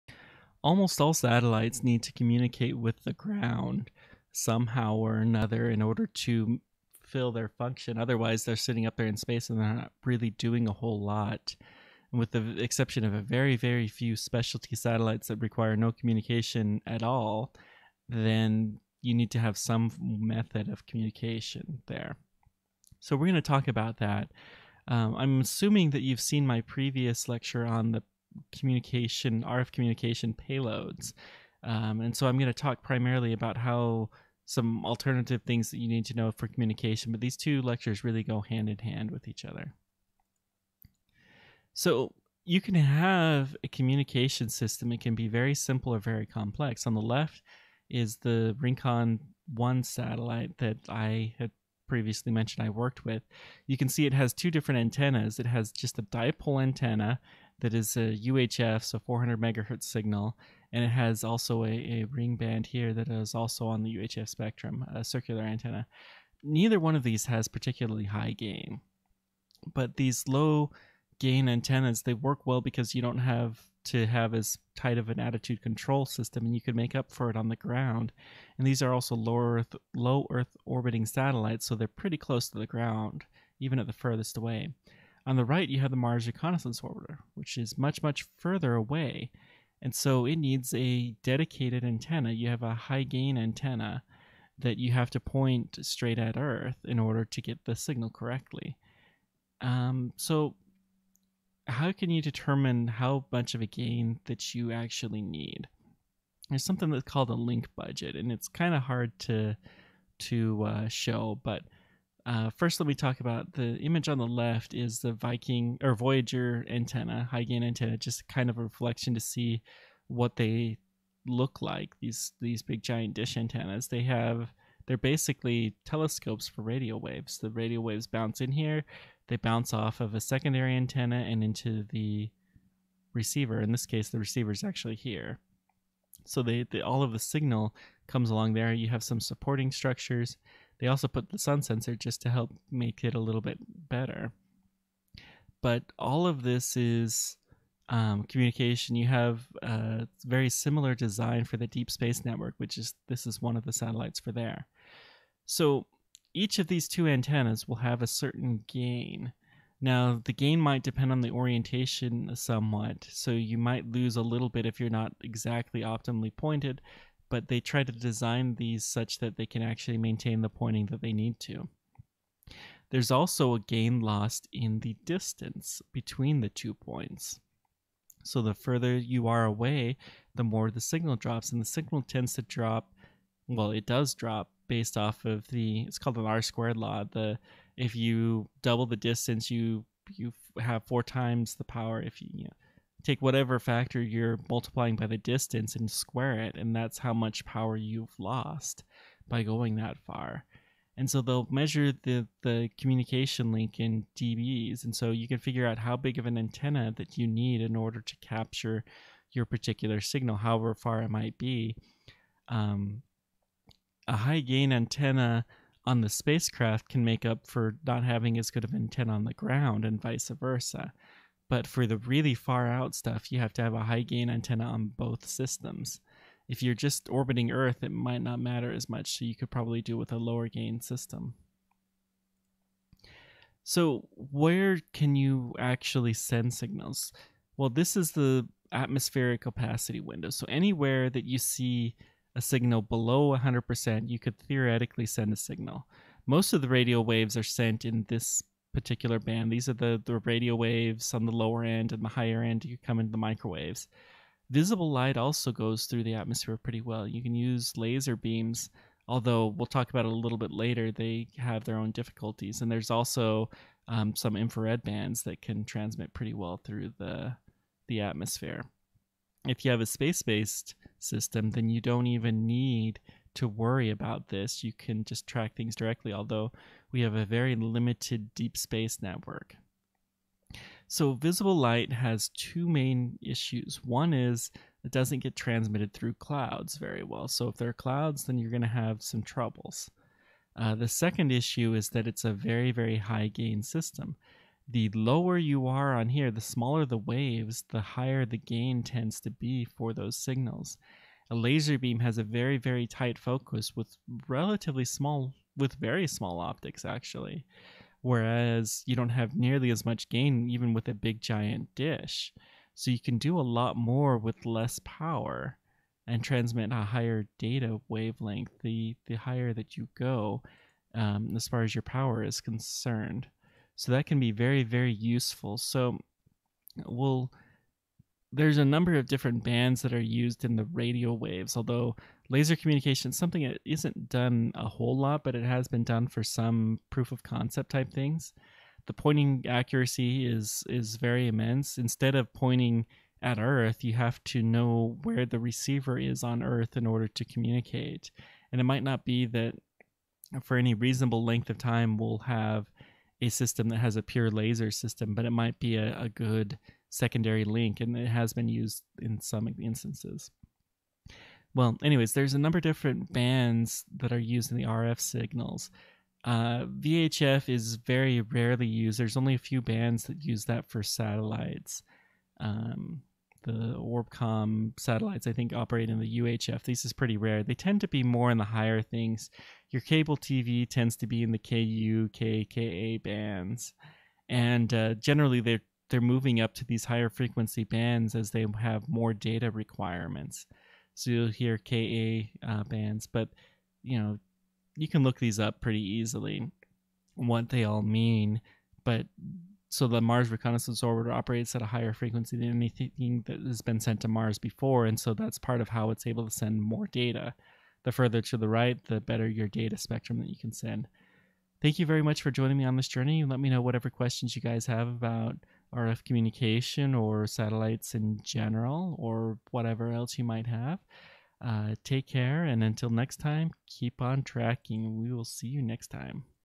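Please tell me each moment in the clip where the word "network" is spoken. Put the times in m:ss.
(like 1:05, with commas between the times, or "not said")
2:32, 4:39.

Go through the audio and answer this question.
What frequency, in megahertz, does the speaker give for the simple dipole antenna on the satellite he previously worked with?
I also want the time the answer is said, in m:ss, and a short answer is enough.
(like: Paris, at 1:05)
400, at 0:58.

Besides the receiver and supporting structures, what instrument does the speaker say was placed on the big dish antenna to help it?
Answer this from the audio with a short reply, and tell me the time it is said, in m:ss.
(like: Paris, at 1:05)
sun sensor, at 2:21.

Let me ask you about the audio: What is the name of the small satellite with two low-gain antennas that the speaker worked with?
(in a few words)
Rincon 1.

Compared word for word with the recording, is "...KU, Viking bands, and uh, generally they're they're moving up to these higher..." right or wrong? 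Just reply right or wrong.
wrong.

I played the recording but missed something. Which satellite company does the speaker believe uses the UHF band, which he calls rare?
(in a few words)
Orbcomm.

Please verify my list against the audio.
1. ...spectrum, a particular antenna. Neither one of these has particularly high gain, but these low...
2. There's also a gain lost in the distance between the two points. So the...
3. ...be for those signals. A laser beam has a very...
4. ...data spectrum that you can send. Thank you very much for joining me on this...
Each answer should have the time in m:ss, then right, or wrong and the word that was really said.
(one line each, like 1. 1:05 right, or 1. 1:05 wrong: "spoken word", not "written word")
1. 1:04 wrong: "circular", not "particular"
2. 2:52 right
3. 4:59 right
4. 6:49 right.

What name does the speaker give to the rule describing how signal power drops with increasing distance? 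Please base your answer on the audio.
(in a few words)
R squared law.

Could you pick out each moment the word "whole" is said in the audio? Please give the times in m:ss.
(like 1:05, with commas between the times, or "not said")
0:10, 5:34.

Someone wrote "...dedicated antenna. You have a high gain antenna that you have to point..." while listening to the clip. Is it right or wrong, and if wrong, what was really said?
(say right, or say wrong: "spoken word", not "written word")
right.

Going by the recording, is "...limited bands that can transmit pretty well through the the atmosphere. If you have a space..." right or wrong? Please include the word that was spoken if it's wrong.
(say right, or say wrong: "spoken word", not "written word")
wrong: "infrared", not "limited".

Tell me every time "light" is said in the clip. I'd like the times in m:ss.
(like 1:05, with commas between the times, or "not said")
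4:14, 4:41.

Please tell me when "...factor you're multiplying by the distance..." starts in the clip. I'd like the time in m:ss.
3:13.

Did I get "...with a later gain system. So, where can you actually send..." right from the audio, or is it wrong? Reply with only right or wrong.
wrong.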